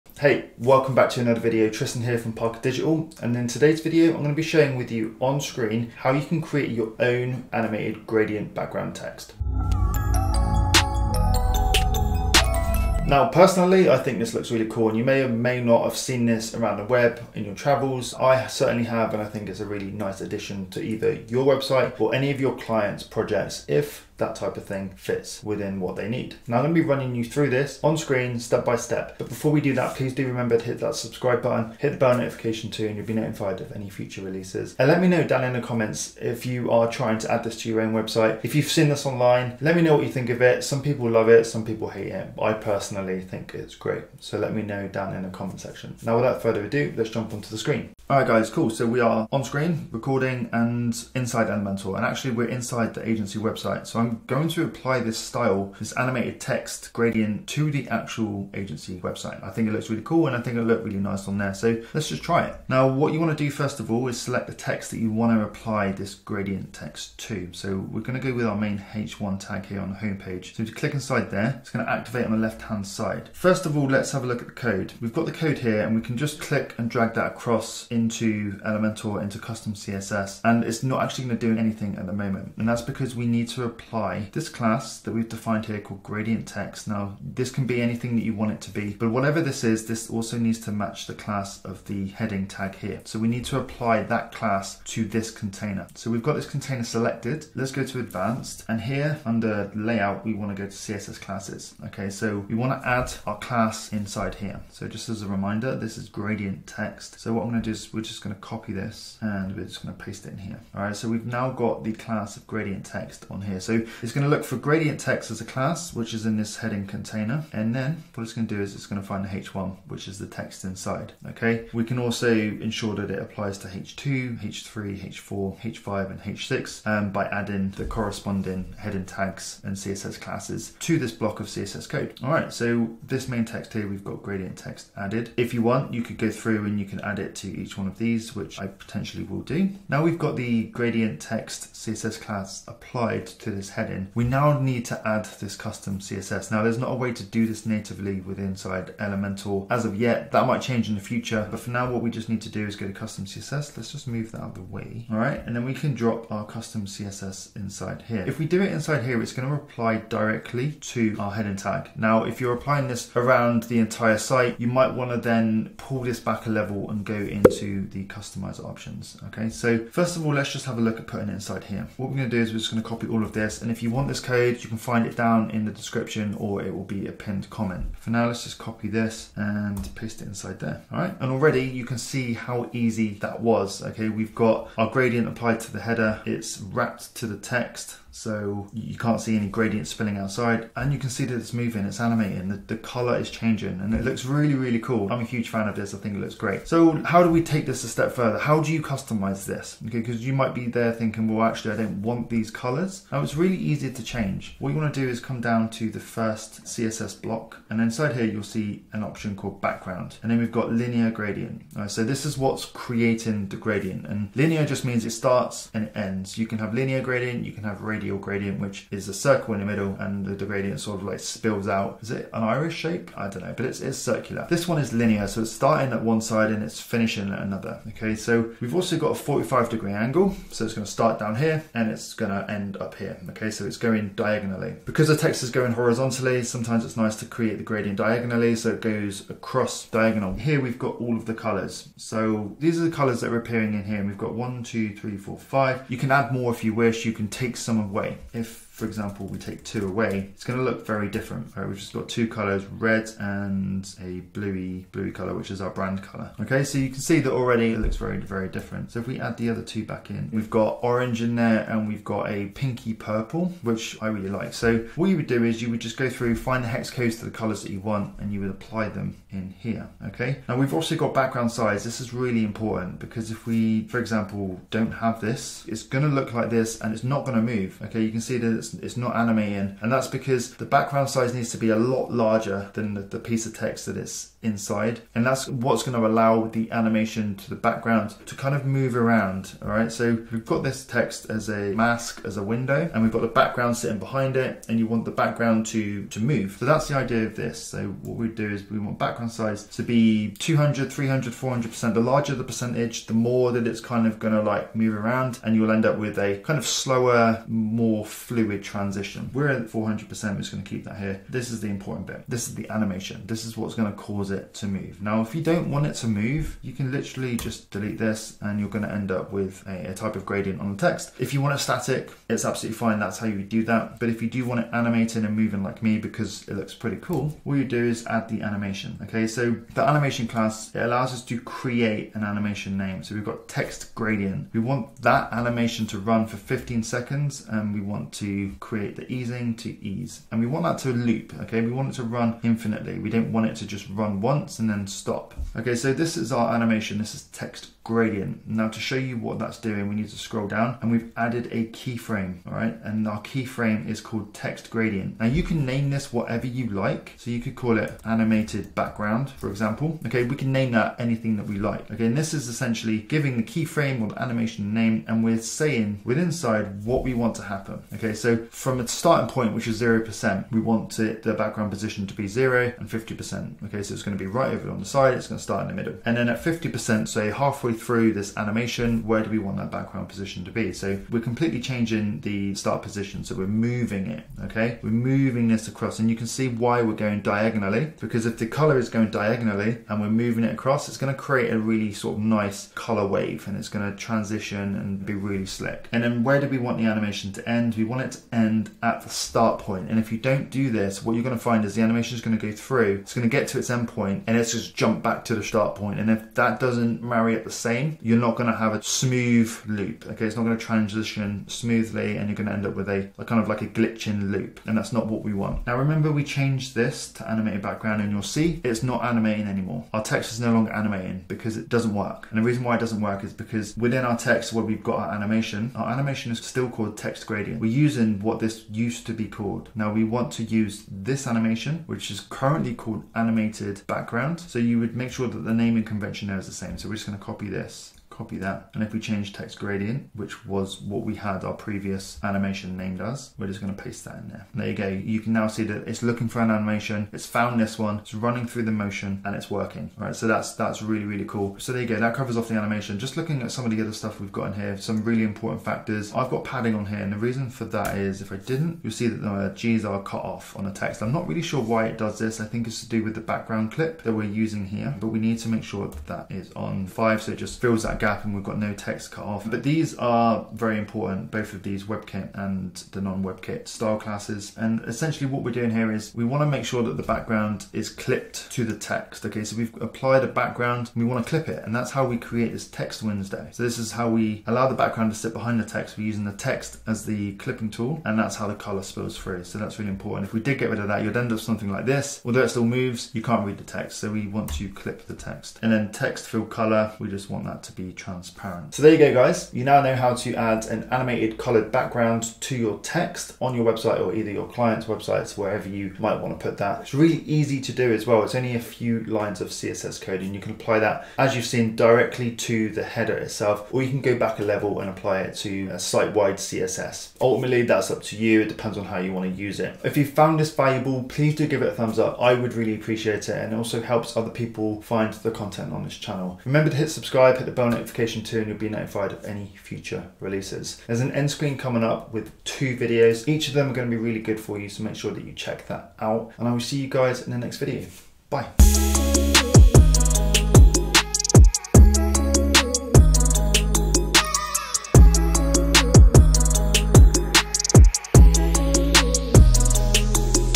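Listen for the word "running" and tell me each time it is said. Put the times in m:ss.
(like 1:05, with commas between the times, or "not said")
0:26, 7:28.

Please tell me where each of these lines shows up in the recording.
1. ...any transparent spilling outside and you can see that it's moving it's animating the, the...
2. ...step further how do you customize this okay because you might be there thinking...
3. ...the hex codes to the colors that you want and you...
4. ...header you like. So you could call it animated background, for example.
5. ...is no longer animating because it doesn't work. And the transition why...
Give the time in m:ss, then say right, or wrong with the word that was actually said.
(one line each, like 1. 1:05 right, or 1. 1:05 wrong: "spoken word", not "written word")
1. 3:09 wrong: "gradient", not "transparent"
2. 3:17 right
3. 4:26 right
4. 5:56 wrong: "whatever", not "header"
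5. 7:00 wrong: "reason", not "transition".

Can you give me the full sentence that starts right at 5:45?
Okay, so this is our animation.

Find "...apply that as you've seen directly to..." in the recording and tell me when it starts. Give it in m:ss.
8:30.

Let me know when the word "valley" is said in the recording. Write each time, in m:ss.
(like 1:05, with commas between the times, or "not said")
not said.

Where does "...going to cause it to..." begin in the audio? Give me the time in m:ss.
5:13.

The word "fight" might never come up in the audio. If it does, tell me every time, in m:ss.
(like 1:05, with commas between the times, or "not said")
not said.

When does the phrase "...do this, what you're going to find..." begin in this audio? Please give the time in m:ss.
6:40.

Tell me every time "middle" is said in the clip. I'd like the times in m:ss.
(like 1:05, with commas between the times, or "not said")
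3:39, 6:15.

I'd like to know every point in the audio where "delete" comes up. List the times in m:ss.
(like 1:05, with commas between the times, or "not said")
5:17.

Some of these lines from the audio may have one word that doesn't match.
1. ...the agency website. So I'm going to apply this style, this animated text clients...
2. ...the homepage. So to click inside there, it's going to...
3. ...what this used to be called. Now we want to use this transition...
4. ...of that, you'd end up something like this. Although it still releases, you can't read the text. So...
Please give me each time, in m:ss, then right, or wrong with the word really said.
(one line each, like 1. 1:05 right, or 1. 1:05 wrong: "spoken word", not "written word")
1. 0:52 wrong: "gradient", not "clients"
2. 1:09 right
3. 7:08 wrong: "animation", not "transition"
4. 8:10 wrong: "moves", not "releases".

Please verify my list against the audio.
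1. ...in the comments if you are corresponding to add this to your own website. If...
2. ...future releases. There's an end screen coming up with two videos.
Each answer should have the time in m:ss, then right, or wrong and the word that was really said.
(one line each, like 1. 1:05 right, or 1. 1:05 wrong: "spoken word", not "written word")
1. 0:35 wrong: "trying", not "corresponding"
2. 8:49 right.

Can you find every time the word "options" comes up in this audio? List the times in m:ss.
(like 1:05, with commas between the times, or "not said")
2:48, 3:29.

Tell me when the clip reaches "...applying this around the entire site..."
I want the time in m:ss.
2:42.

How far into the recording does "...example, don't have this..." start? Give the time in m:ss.
4:33.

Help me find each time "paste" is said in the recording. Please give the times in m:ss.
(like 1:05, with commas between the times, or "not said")
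1:50, 2:59, 7:23.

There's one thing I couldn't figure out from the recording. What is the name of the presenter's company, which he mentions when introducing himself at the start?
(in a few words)
Parker Digital.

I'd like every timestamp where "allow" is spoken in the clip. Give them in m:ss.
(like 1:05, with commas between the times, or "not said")
4:46, 5:30, 8:04.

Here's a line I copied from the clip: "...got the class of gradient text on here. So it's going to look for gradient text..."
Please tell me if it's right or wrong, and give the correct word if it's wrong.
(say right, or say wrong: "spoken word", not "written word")
right.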